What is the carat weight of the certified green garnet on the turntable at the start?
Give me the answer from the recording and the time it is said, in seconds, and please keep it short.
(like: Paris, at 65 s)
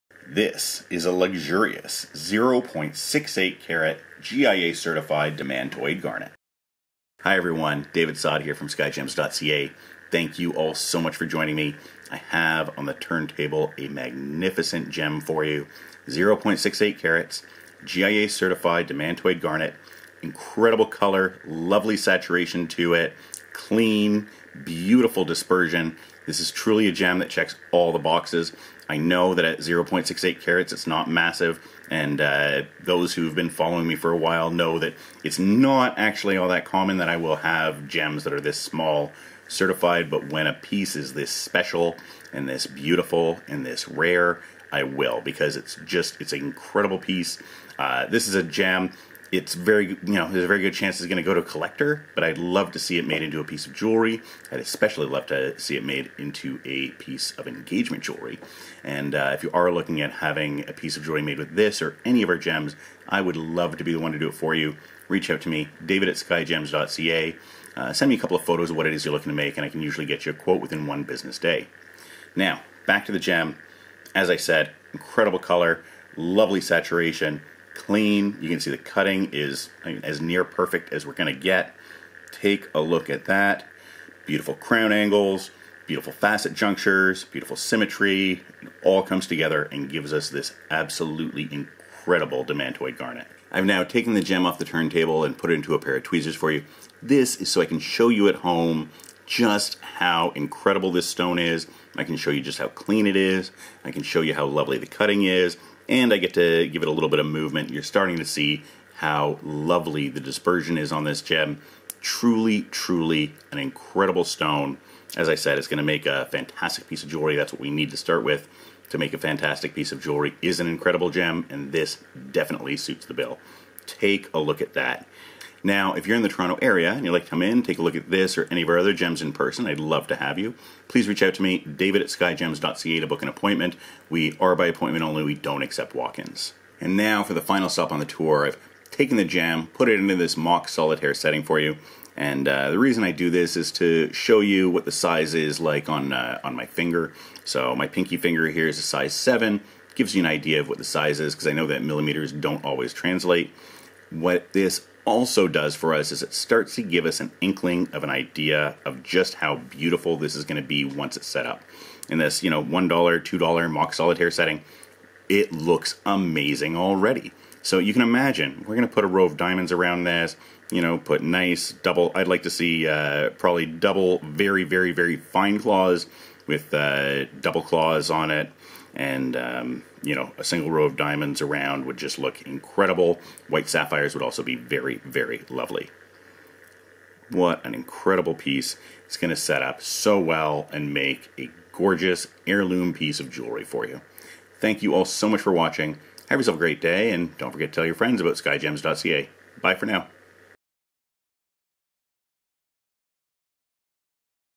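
0.68, at 16 s.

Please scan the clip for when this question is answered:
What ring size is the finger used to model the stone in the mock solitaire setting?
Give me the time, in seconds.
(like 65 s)
148 s.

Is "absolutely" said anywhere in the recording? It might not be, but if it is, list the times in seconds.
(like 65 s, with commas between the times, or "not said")
90 s.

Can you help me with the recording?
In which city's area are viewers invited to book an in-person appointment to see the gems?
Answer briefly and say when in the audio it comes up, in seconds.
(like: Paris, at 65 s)
Toronto, at 126 s.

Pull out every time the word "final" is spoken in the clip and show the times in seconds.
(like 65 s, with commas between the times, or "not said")
137 s.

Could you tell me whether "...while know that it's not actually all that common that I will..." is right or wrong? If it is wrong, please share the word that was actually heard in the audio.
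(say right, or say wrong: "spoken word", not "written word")
right.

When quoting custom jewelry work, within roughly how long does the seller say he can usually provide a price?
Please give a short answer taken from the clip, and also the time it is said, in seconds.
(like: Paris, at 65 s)
one business day, at 70 s.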